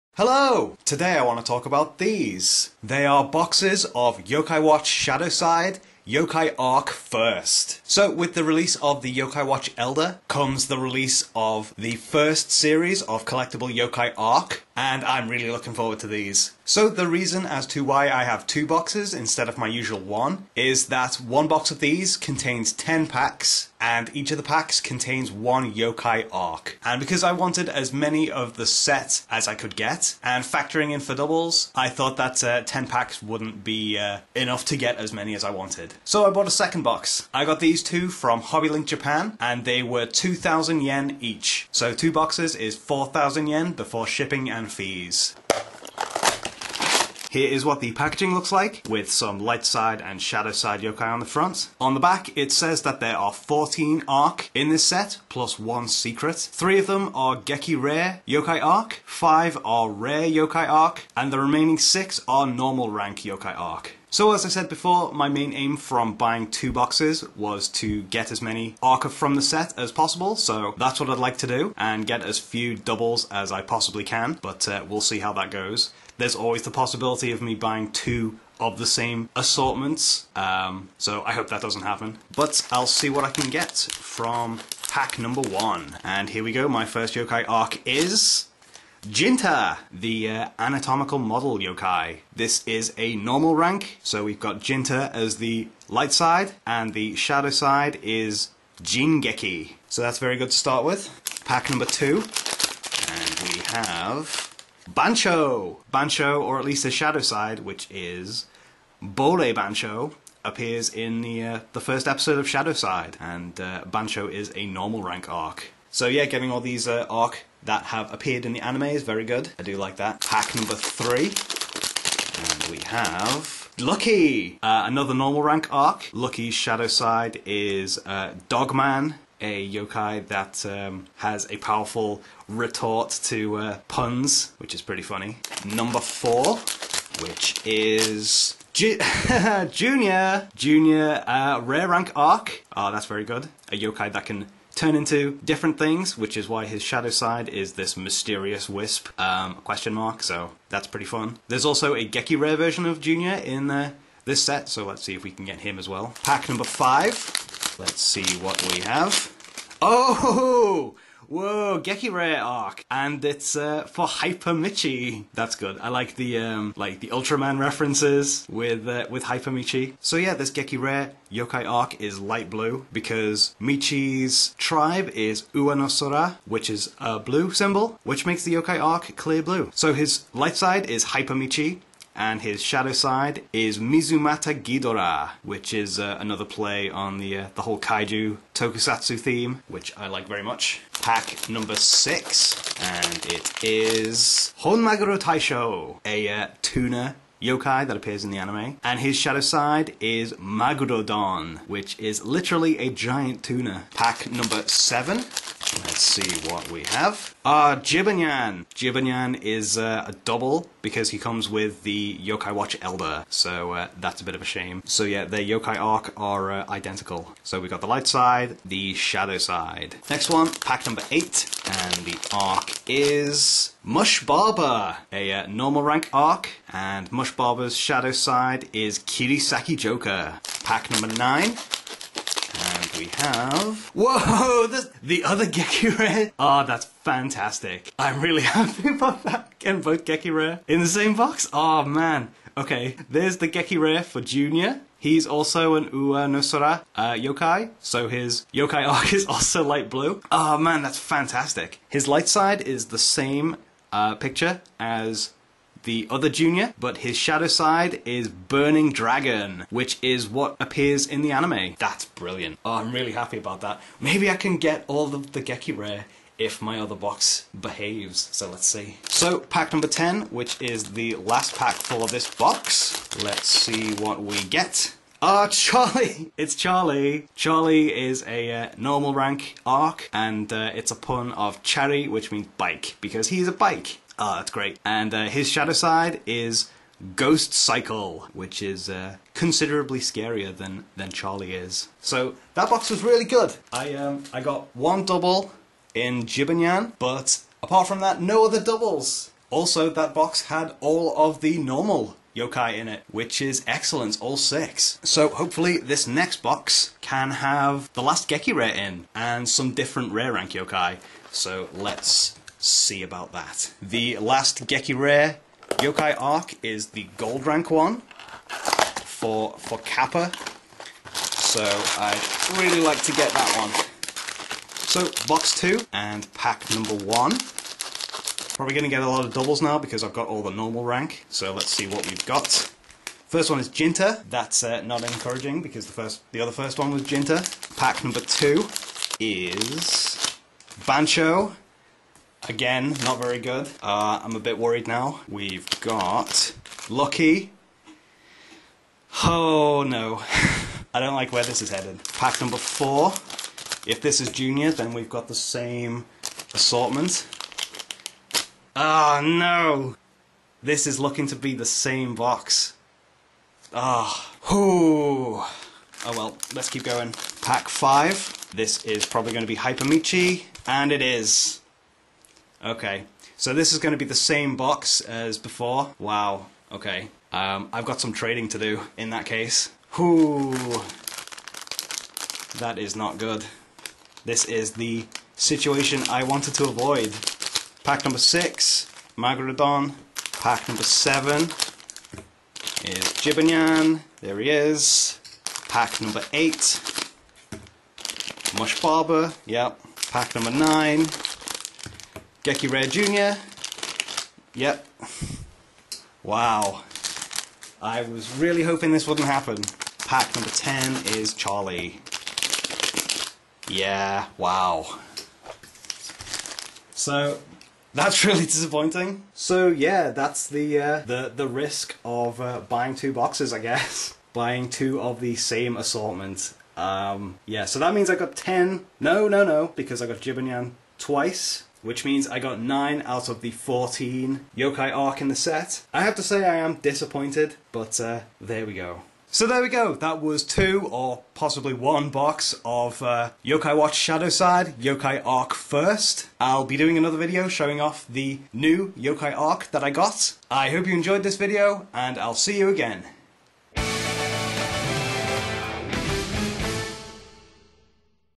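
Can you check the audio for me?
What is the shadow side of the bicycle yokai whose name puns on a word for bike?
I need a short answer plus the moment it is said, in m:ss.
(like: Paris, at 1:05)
Ghost Cycle, at 4:47.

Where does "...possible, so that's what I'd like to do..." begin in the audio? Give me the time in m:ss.
1:09.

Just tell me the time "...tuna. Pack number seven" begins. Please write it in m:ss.
3:23.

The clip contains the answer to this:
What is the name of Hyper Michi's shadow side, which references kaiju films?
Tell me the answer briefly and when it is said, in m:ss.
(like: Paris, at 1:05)
Mizumata Ghidorah, at 3:03.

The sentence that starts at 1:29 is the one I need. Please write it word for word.
Jinta, the uh, anatomical model yokai.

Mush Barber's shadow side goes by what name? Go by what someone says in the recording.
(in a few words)
Kirisaki Joker.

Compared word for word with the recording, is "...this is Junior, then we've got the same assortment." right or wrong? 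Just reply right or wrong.
right.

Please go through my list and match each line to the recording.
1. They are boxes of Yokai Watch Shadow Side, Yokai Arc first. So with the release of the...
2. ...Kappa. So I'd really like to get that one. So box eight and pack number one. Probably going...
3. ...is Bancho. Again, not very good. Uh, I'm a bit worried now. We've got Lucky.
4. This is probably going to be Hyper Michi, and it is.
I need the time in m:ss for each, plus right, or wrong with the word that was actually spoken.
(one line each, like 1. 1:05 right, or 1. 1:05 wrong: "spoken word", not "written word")
1. 0:02 right
2. 5:19 wrong: "two", not "eight"
3. 5:39 right
4. 6:08 right.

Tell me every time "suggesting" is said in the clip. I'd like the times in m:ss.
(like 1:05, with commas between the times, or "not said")
not said.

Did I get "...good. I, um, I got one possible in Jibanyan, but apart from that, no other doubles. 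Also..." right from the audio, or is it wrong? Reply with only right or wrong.
wrong.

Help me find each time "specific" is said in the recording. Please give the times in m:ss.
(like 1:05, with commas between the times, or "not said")
not said.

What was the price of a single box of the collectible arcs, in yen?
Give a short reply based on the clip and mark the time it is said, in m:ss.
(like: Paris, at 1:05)
2,000 yen, at 0:40.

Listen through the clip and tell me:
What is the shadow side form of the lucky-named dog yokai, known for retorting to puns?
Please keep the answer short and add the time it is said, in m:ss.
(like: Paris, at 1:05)
Dogman, at 2:08.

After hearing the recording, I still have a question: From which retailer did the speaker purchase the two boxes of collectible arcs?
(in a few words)
Hobbylink Japan.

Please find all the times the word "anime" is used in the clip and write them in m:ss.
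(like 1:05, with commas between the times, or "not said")
1:58, 3:18, 4:21.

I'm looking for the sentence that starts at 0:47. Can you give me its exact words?
Here is what the packaging looks like, with some light side and shadow side yokai on the front.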